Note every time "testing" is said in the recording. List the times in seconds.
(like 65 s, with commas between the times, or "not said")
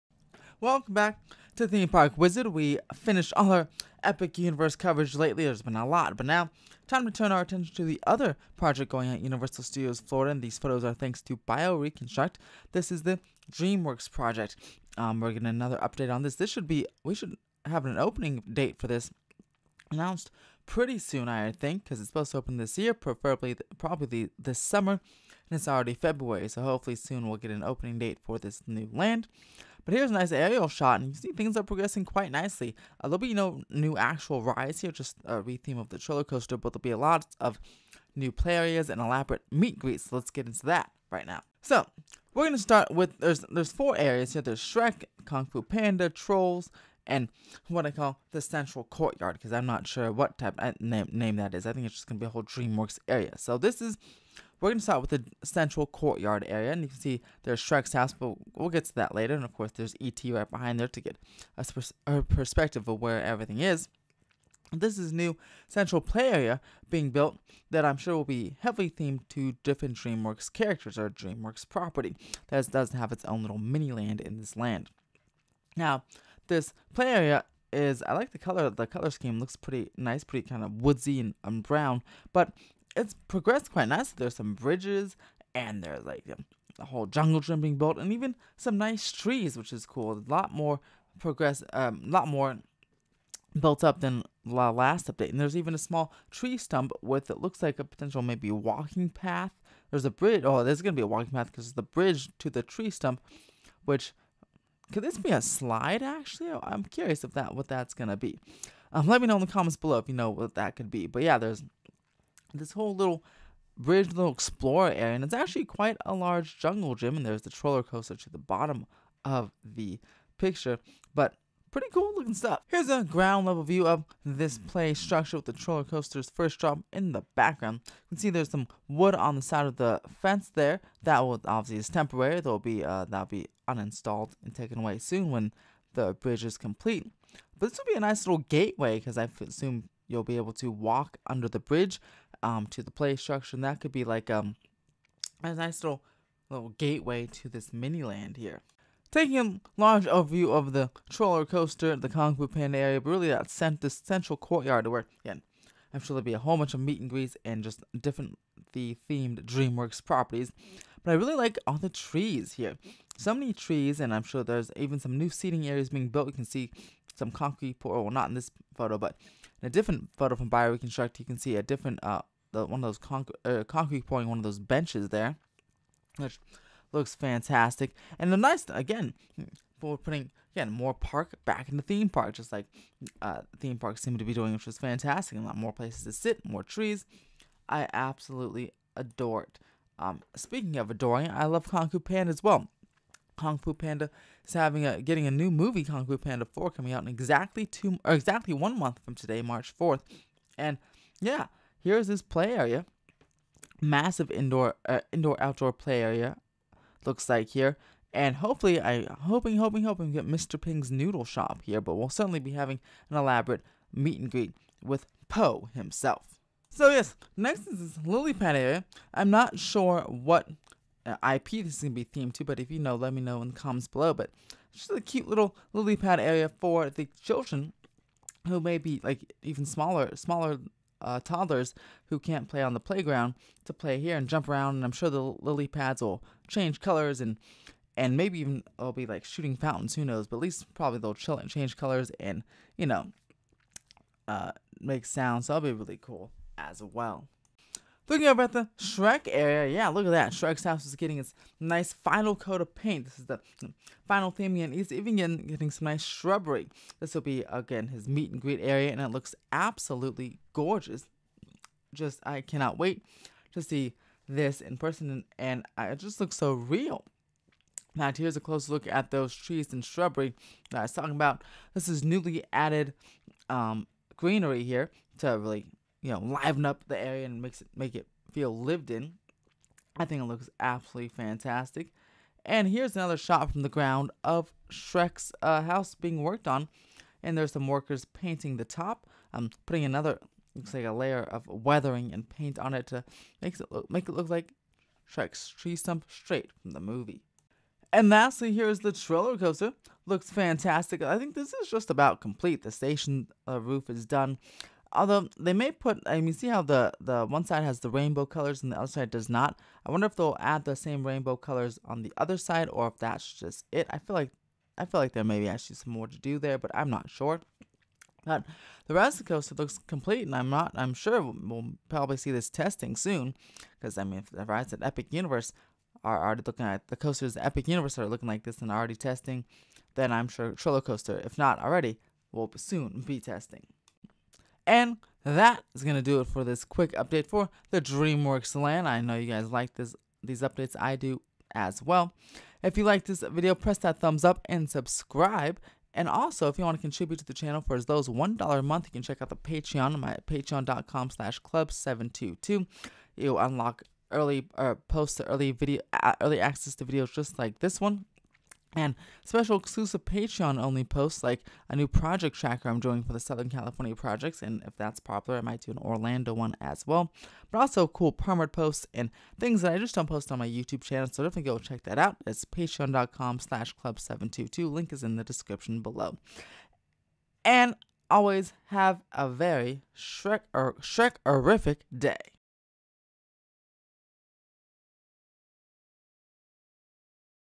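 322 s, 328 s, 333 s.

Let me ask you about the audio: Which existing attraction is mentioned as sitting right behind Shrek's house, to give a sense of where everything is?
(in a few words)
E.T.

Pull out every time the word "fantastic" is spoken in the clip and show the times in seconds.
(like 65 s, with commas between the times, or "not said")
177 s, 184 s, 281 s, 300 s.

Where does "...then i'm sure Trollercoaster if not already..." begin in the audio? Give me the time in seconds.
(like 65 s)
329 s.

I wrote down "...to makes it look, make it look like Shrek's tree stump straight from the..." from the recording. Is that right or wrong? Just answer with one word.
right.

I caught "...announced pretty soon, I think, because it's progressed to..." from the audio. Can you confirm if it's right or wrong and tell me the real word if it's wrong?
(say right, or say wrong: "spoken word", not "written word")
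wrong: "supposed", not "progressed".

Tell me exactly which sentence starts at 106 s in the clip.
I'm curious if that what that's gonna be.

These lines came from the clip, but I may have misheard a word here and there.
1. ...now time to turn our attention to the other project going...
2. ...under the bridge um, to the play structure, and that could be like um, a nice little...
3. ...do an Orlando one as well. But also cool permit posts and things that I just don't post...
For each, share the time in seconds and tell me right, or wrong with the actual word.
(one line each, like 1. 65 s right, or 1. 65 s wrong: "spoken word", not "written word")
1. 6 s right
2. 141 s right
3. 365 s right.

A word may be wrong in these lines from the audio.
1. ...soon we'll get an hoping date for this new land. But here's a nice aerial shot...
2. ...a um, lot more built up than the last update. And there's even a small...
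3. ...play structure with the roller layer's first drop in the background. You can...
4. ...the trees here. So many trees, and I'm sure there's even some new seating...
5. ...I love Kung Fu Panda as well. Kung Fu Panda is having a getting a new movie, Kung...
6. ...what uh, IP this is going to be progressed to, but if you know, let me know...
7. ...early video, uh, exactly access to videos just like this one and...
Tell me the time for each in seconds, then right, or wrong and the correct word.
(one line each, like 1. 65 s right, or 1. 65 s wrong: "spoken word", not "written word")
1. 26 s wrong: "opening", not "hoping"
2. 92 s right
3. 124 s wrong: "coaster", not "layer"
4. 161 s right
5. 191 s right
6. 220 s wrong: "themed", not "progressed"
7. 355 s wrong: "early", not "exactly".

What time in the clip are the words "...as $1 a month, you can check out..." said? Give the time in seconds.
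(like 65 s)
347 s.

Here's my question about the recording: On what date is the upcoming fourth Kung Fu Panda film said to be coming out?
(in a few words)
March 4th.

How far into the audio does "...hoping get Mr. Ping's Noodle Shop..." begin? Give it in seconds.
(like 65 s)
209 s.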